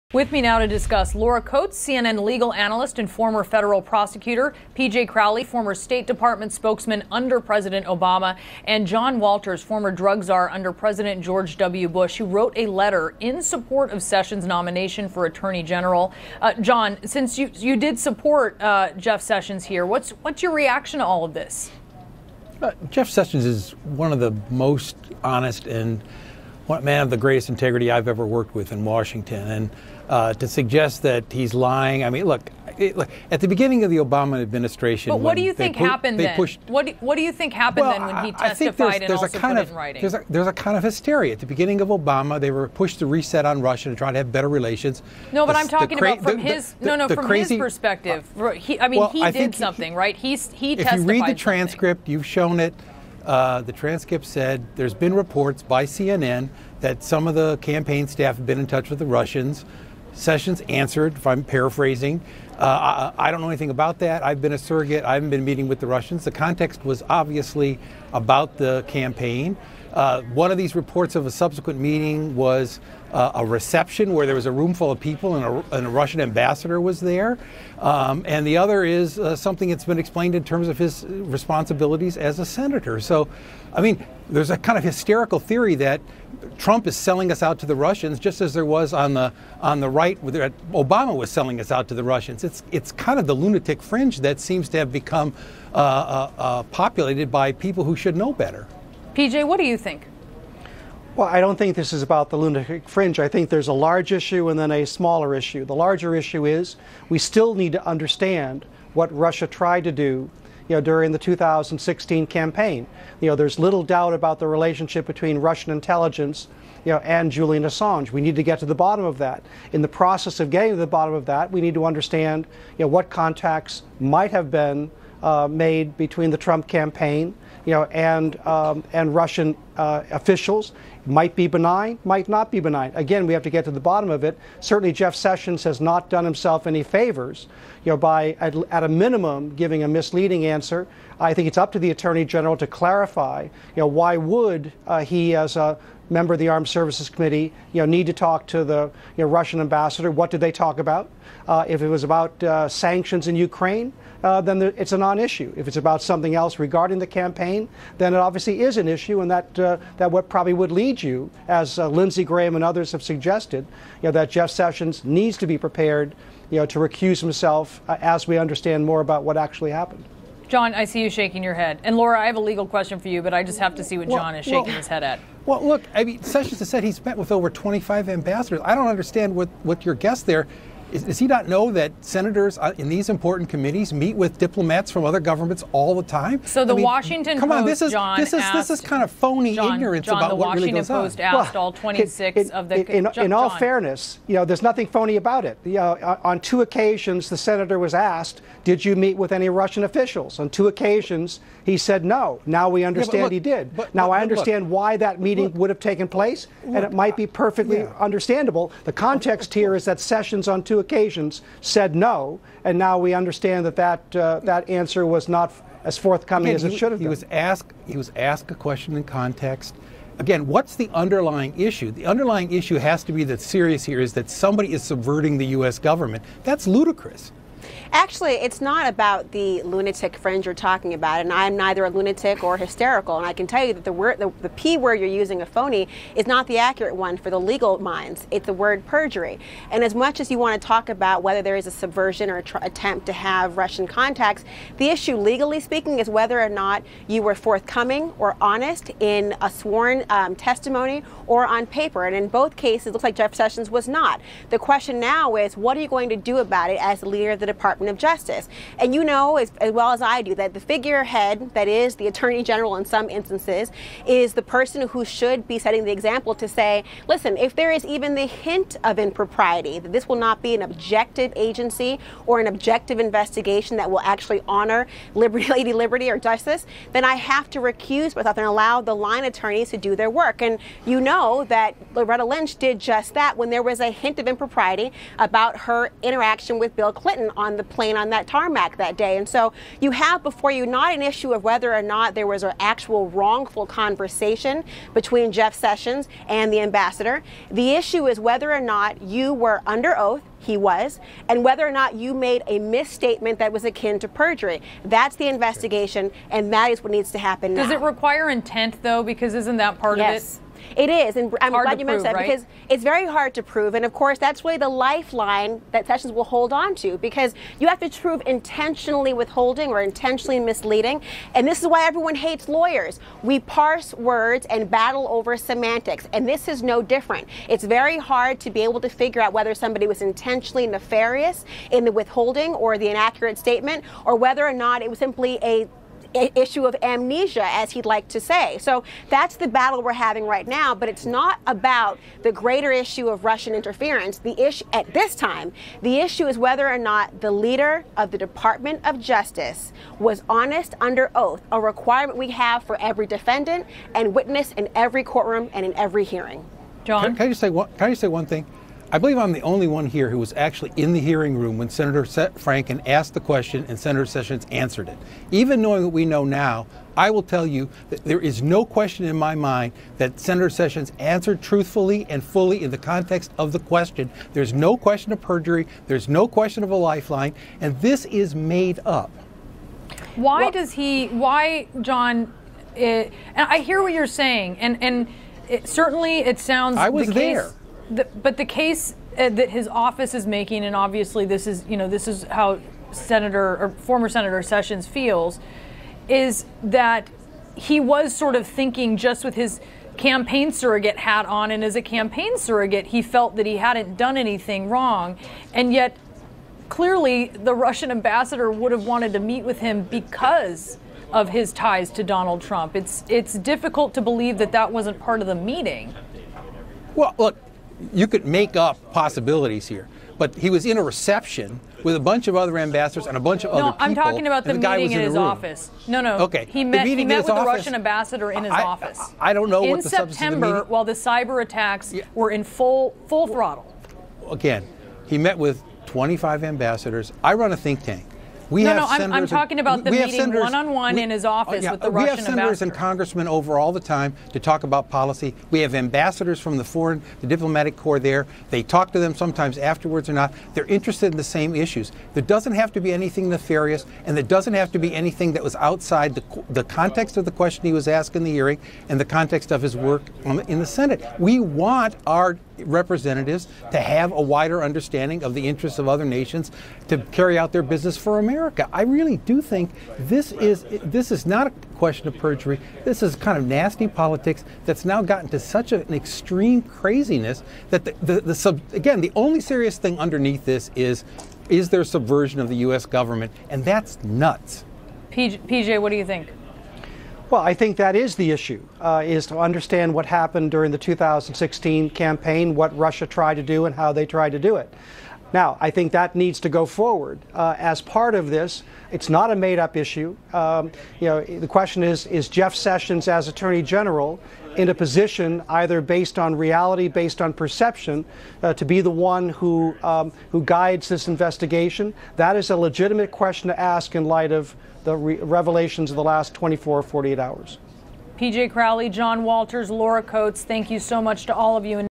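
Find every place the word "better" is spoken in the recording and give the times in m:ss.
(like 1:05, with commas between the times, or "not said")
0:44, 1:38.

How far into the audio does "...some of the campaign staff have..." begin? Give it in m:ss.
0:57.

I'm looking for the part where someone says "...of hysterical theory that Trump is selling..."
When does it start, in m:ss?
1:24.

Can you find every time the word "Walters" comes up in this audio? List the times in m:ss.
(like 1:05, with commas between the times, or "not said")
0:09, 8:39.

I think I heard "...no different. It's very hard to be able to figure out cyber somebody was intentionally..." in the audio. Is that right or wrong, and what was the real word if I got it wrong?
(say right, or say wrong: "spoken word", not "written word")
wrong: "whether", not "cyber".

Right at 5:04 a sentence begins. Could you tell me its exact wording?
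That's the investigation, and that is what needs to happen Does now.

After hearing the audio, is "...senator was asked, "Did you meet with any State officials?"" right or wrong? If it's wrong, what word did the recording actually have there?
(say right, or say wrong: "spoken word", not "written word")
wrong: "Russian", not "State".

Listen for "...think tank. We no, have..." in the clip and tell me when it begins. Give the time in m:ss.
7:17.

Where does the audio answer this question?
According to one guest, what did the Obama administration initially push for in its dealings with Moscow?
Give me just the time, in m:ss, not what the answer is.
0:43.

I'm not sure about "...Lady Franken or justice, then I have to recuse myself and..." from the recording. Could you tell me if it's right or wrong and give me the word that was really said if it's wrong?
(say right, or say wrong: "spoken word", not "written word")
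wrong: "Liberty", not "Franken".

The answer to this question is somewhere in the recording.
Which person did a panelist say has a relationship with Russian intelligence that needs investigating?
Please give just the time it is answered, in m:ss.
1:57.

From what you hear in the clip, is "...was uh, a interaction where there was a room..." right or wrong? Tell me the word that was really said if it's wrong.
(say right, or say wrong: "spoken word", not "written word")
wrong: "reception", not "interaction".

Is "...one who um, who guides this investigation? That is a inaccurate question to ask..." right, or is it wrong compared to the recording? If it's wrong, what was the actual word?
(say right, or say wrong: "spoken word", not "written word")
wrong: "legitimate", not "inaccurate".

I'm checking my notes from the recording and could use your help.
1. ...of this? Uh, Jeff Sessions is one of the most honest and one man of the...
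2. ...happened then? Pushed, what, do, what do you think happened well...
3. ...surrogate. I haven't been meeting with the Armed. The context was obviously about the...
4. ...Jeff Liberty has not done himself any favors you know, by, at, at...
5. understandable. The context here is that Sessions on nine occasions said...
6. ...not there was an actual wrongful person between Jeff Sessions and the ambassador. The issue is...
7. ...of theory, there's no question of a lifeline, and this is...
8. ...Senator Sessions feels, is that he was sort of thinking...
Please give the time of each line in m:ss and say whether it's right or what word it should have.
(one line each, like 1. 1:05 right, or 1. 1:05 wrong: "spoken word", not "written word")
1. 0:21 right
2. 0:35 right
3. 1:04 wrong: "Russians", not "Armed"
4. 2:14 wrong: "Sessions", not "Liberty"
5. 3:27 wrong: "two", not "nine"
6. 4:51 wrong: "conversation", not "person"
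7. 6:15 wrong: "perjury", not "theory"
8. 6:34 right.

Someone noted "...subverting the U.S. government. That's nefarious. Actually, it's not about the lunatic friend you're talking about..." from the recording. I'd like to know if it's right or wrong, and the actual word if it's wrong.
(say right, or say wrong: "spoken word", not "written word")
wrong: "ludicrous", not "nefarious".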